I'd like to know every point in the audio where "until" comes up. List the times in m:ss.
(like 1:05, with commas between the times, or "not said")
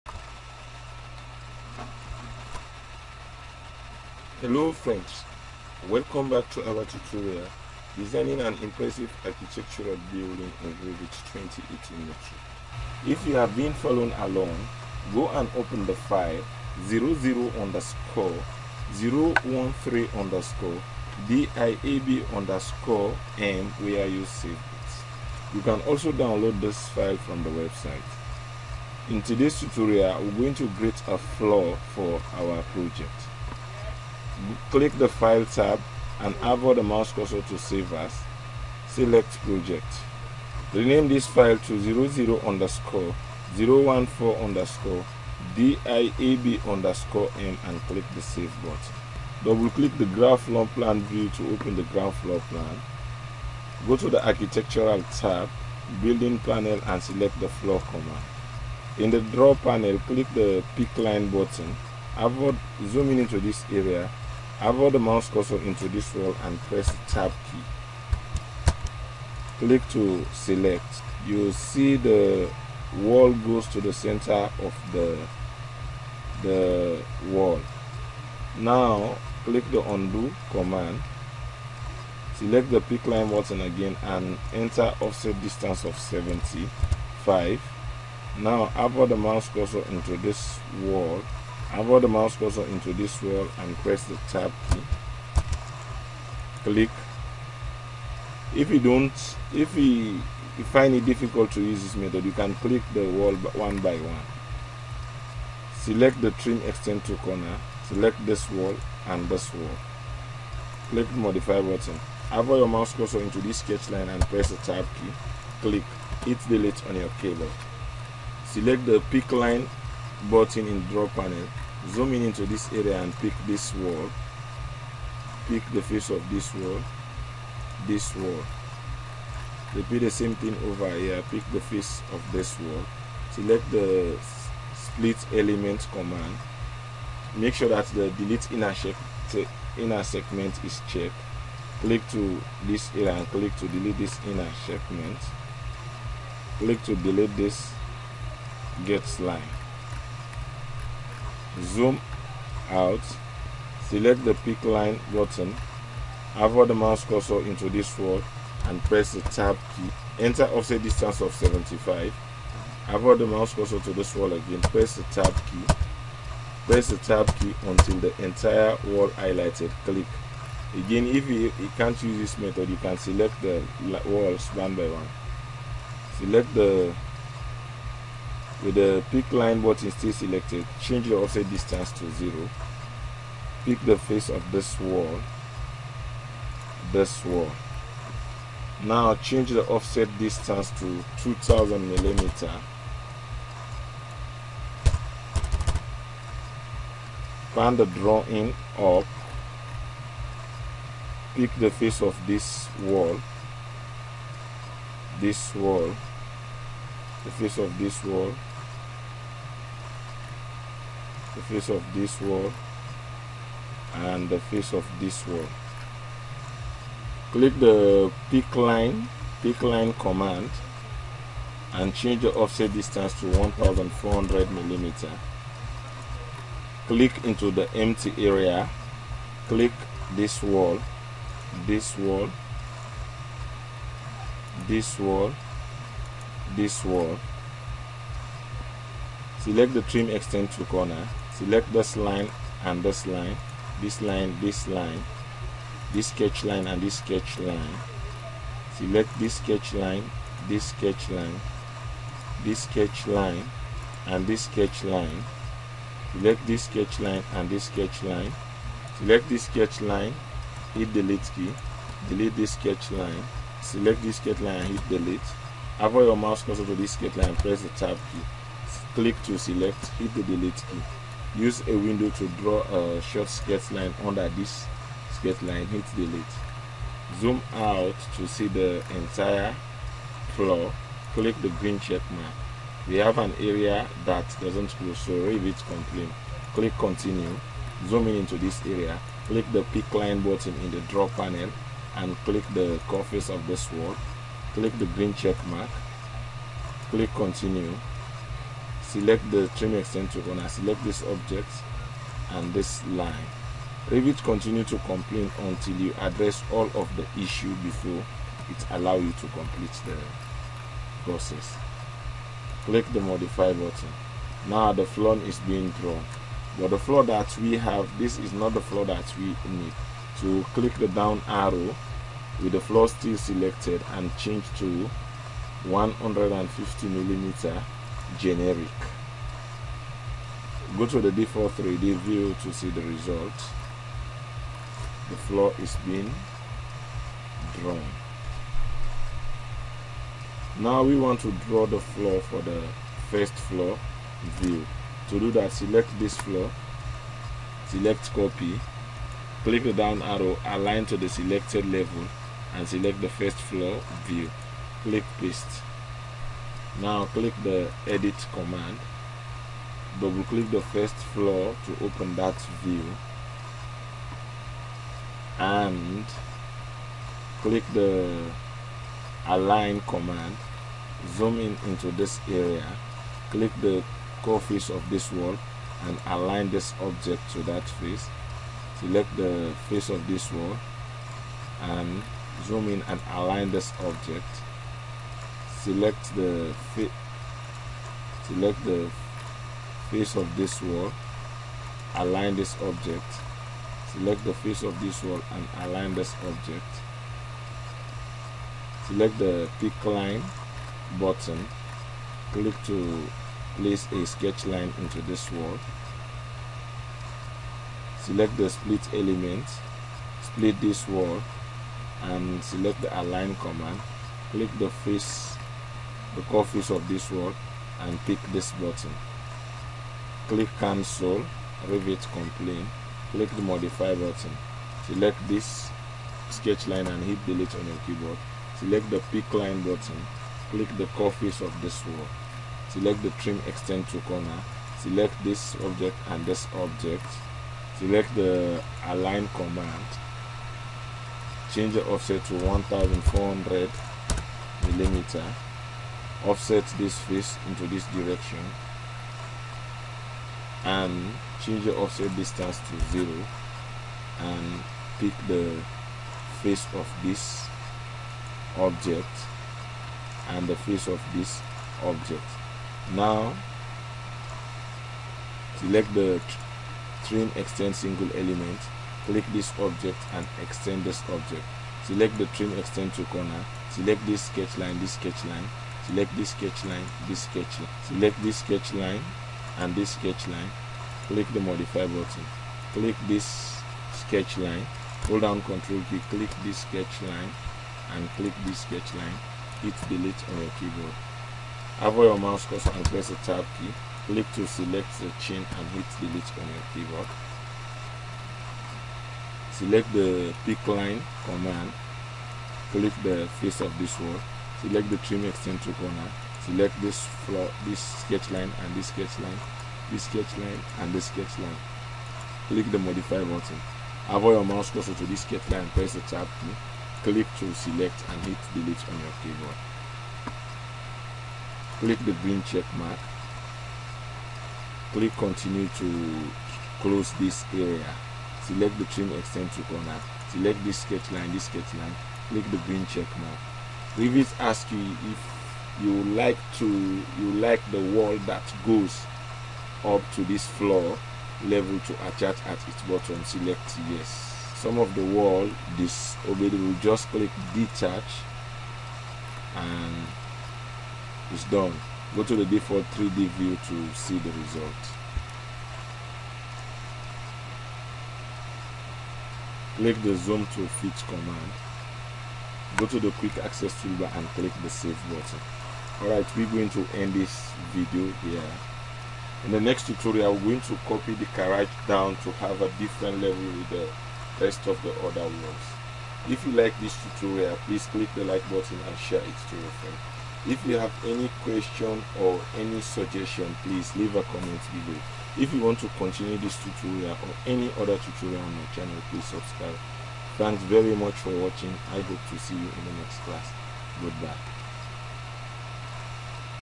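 2:47, 5:05.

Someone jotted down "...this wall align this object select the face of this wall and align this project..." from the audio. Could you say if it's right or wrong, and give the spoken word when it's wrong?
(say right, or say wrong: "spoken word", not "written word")
wrong: "object", not "project".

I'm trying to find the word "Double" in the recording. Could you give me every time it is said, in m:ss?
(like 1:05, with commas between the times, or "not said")
0:49, 5:59.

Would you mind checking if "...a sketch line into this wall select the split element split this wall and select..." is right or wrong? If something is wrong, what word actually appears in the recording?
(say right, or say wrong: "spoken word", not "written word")
right.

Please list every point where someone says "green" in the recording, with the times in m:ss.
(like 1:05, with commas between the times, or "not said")
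4:41, 4:54, 8:42, 8:52.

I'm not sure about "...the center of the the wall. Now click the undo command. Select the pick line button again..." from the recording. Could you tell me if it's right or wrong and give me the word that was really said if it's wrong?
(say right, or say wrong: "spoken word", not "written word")
right.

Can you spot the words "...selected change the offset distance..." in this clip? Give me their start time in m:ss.
3:00.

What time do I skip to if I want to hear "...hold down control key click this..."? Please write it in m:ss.
8:05.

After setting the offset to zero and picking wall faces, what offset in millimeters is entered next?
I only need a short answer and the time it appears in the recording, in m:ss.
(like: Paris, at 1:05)
2000 millimeter, at 3:11.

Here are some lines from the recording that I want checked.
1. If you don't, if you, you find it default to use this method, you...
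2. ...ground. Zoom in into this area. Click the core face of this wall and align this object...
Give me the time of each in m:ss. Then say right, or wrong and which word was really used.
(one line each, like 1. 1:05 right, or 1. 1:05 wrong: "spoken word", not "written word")
1. 1:38 wrong: "difficult", not "default"
2. 6:09 wrong: "command", not "ground".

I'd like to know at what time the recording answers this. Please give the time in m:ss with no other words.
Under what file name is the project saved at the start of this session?
0:42.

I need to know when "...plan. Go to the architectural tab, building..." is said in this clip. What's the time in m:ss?
0:52.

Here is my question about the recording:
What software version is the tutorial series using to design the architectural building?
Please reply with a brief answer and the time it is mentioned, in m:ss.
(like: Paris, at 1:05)
Revit 2018, at 0:10.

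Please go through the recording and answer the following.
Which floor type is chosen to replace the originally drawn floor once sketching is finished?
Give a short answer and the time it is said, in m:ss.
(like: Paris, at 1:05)
150 millimeter generic, at 5:25.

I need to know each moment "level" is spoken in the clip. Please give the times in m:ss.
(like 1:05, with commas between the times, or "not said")
5:51, 9:01, 9:33.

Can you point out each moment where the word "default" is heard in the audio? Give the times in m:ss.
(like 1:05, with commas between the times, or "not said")
5:31, 9:12.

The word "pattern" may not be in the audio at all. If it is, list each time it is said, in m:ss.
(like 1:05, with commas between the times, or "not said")
not said.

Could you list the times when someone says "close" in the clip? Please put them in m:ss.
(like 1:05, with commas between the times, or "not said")
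8:46.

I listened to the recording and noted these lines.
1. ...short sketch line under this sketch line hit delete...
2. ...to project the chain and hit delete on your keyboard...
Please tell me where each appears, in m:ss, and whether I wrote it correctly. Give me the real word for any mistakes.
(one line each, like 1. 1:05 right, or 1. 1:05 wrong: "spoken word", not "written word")
1. 4:33 right
2. 8:14 wrong: "select", not "project".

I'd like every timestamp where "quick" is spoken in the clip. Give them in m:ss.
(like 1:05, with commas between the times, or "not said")
9:23.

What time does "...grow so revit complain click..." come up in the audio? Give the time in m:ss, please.
4:44.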